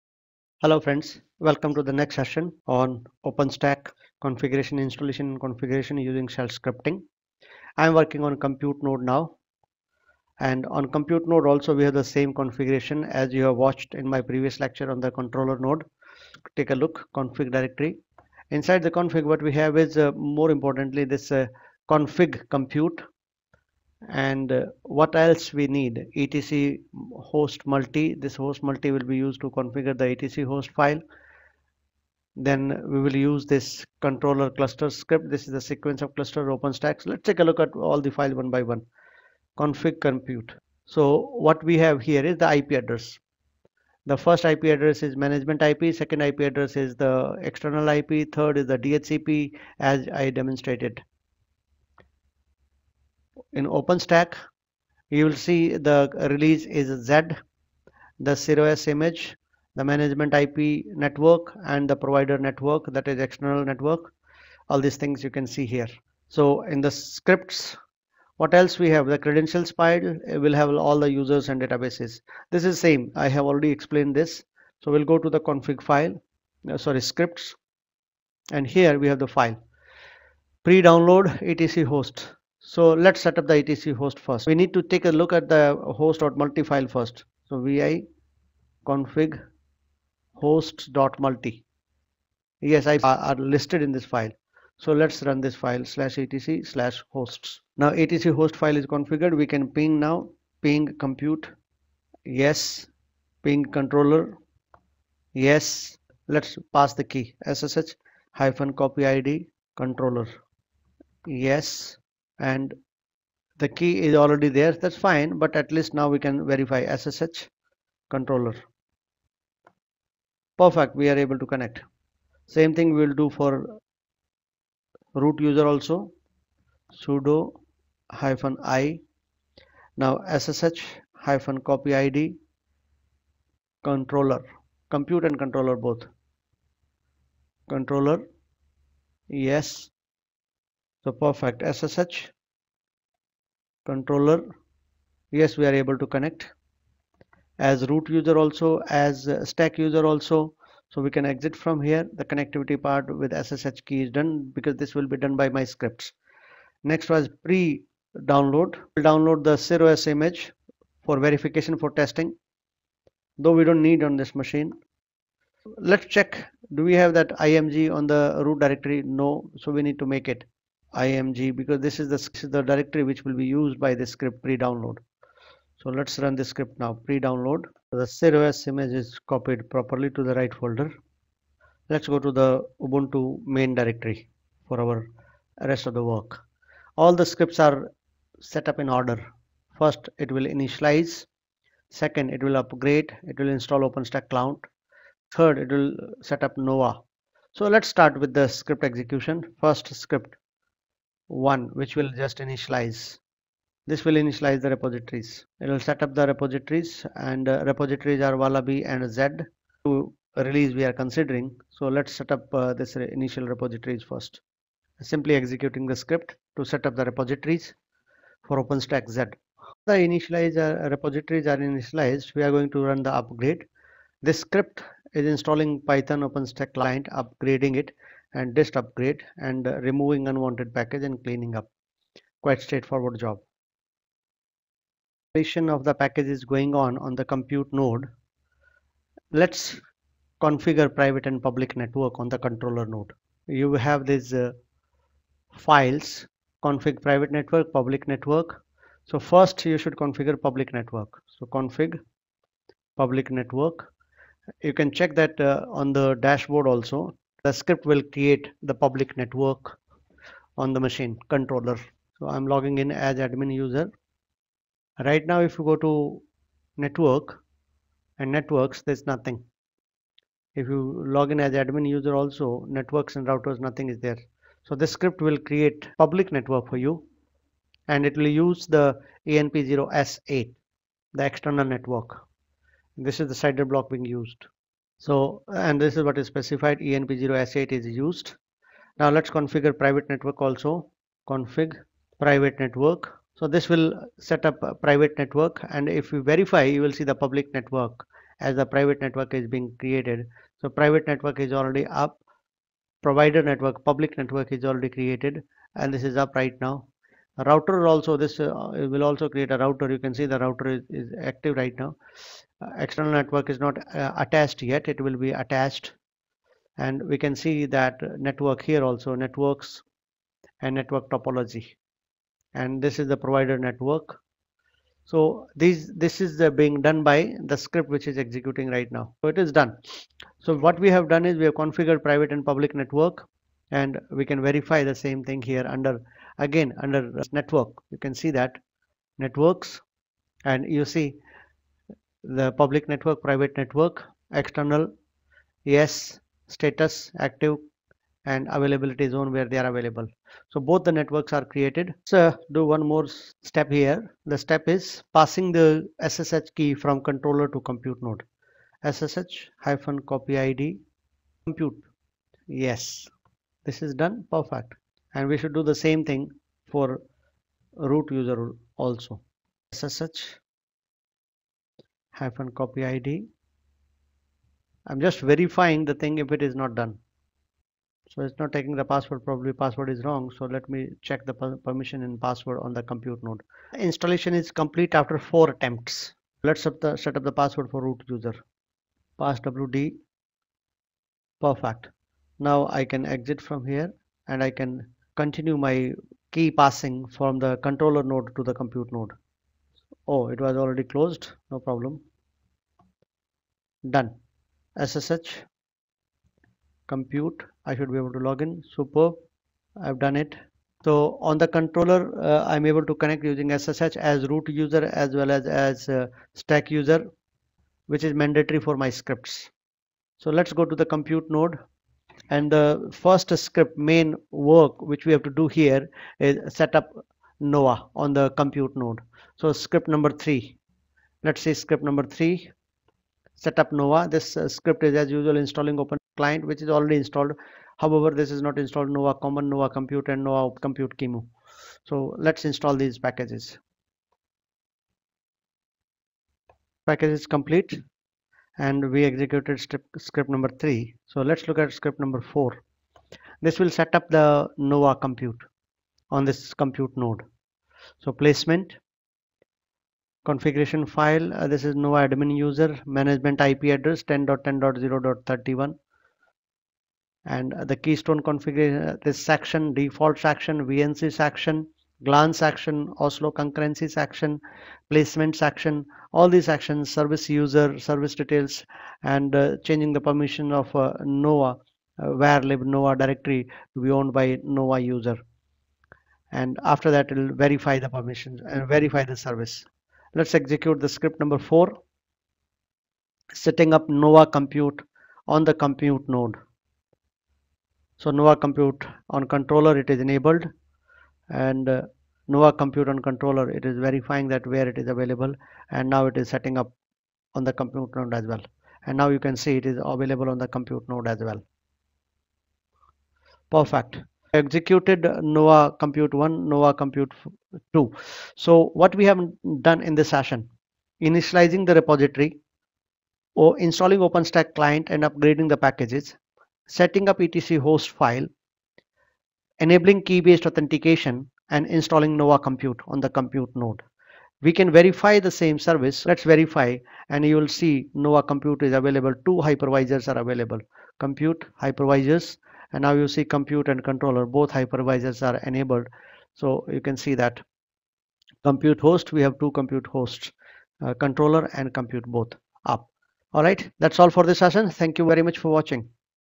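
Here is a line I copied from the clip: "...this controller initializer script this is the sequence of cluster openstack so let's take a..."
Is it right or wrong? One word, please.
wrong.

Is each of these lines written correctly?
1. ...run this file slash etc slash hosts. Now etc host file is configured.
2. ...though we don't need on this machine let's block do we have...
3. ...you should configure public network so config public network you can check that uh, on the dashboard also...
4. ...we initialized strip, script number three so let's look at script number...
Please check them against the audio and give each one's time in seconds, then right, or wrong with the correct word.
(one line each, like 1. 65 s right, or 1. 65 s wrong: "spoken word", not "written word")
1. 95 s right
2. 163 s wrong: "check", not "block"
3. 249 s right
4. 448 s wrong: "executed", not "initialized".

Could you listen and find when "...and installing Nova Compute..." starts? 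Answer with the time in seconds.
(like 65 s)
531 s.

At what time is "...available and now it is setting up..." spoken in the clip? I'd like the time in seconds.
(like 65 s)
504 s.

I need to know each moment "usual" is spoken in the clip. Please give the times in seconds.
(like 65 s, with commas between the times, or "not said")
435 s.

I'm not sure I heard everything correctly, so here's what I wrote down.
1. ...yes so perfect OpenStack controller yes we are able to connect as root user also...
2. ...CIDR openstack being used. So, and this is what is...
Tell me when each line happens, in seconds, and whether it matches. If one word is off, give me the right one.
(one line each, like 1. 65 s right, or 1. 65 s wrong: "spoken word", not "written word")
1. 139 s wrong: "SSH", not "OpenStack"
2. 283 s wrong: "block", not "openstack".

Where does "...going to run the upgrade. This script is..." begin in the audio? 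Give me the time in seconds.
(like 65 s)
222 s.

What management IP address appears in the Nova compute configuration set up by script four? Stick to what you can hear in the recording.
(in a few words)
10.10.0.31.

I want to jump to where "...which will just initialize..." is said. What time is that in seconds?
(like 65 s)
201 s.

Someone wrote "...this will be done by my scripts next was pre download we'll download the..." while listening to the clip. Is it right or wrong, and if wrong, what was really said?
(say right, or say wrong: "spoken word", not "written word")
right.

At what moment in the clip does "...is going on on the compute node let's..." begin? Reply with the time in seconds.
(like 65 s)
236 s.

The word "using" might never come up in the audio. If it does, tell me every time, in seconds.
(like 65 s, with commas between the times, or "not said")
5 s, 413 s.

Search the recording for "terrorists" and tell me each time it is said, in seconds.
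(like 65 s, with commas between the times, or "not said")
not said.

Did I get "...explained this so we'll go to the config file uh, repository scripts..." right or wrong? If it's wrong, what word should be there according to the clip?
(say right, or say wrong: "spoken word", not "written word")
wrong: "sorry", not "repository".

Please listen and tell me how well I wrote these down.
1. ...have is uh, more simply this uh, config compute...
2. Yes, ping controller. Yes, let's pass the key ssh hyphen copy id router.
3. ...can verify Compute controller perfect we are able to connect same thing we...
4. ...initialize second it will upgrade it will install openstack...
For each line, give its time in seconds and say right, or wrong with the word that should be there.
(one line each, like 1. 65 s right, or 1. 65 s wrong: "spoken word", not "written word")
1. 19 s wrong: "importantly", not "simply"
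2. 102 s wrong: "controller", not "router"
3. 116 s wrong: "SSH", not "Compute"
4. 190 s right.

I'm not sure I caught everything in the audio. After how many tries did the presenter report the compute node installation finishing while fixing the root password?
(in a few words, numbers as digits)
4.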